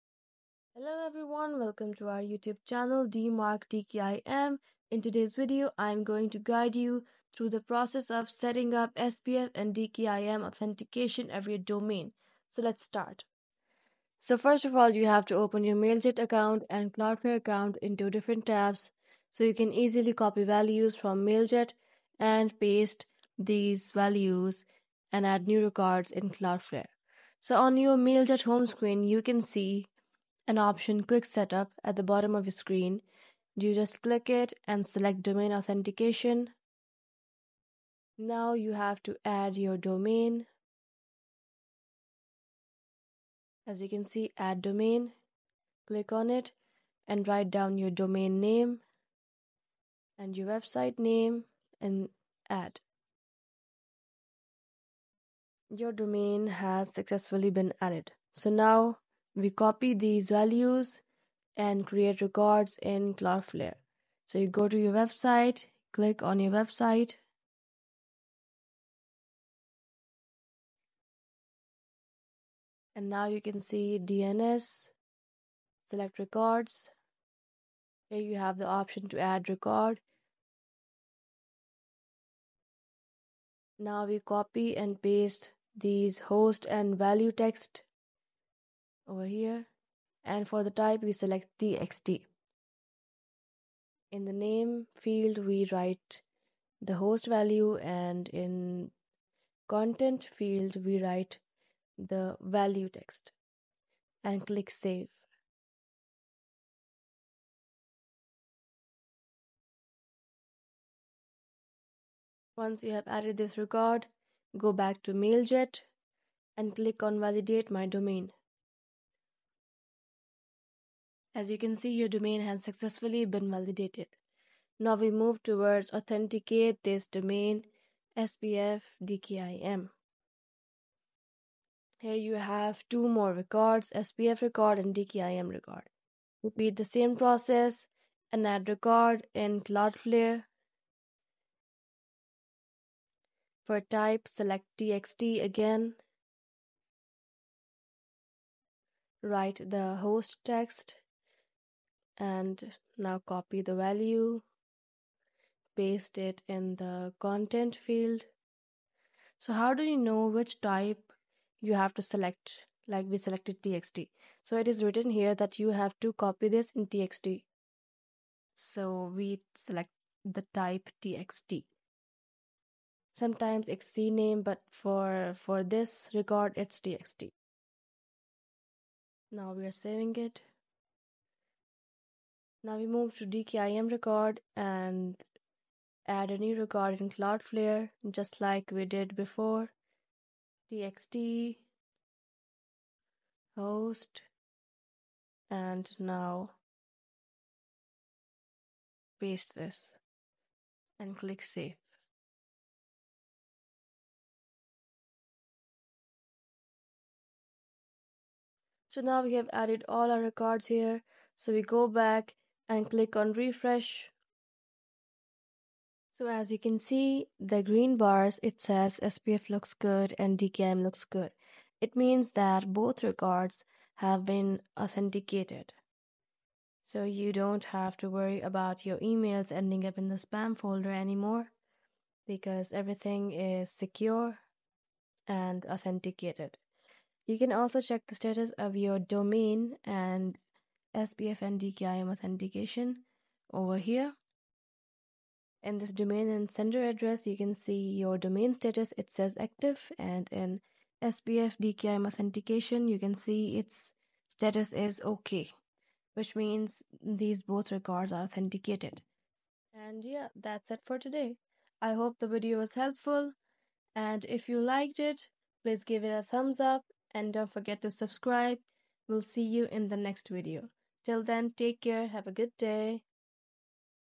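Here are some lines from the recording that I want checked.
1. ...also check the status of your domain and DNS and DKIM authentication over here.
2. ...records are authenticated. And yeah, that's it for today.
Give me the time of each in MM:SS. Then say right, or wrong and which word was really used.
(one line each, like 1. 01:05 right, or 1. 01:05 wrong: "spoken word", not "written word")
1. 03:57 wrong: "SPF", not "DNS"
2. 04:17 right.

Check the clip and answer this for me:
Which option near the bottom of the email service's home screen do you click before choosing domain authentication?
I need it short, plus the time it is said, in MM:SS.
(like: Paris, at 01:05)
Quick Setup, at 00:31.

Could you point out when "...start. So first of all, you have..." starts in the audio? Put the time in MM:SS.
00:12.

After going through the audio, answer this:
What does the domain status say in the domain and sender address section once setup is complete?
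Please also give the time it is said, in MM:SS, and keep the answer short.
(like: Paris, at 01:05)
Active, at 04:09.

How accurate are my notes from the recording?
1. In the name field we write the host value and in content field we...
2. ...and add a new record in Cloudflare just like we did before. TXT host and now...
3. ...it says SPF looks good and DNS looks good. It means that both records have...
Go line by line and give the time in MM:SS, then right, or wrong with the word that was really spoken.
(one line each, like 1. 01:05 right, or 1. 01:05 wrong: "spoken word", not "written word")
1. 01:34 right
2. 03:04 right
3. 03:38 wrong: "DKIM", not "DNS".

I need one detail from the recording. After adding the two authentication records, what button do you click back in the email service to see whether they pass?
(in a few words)
Refresh.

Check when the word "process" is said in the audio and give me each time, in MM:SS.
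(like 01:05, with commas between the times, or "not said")
00:07, 02:17.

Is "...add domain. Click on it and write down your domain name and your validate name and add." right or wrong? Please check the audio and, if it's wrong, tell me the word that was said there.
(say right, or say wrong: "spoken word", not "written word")
wrong: "website", not "validate".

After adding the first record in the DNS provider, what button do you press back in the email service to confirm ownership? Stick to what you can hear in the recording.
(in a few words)
Validate my domain.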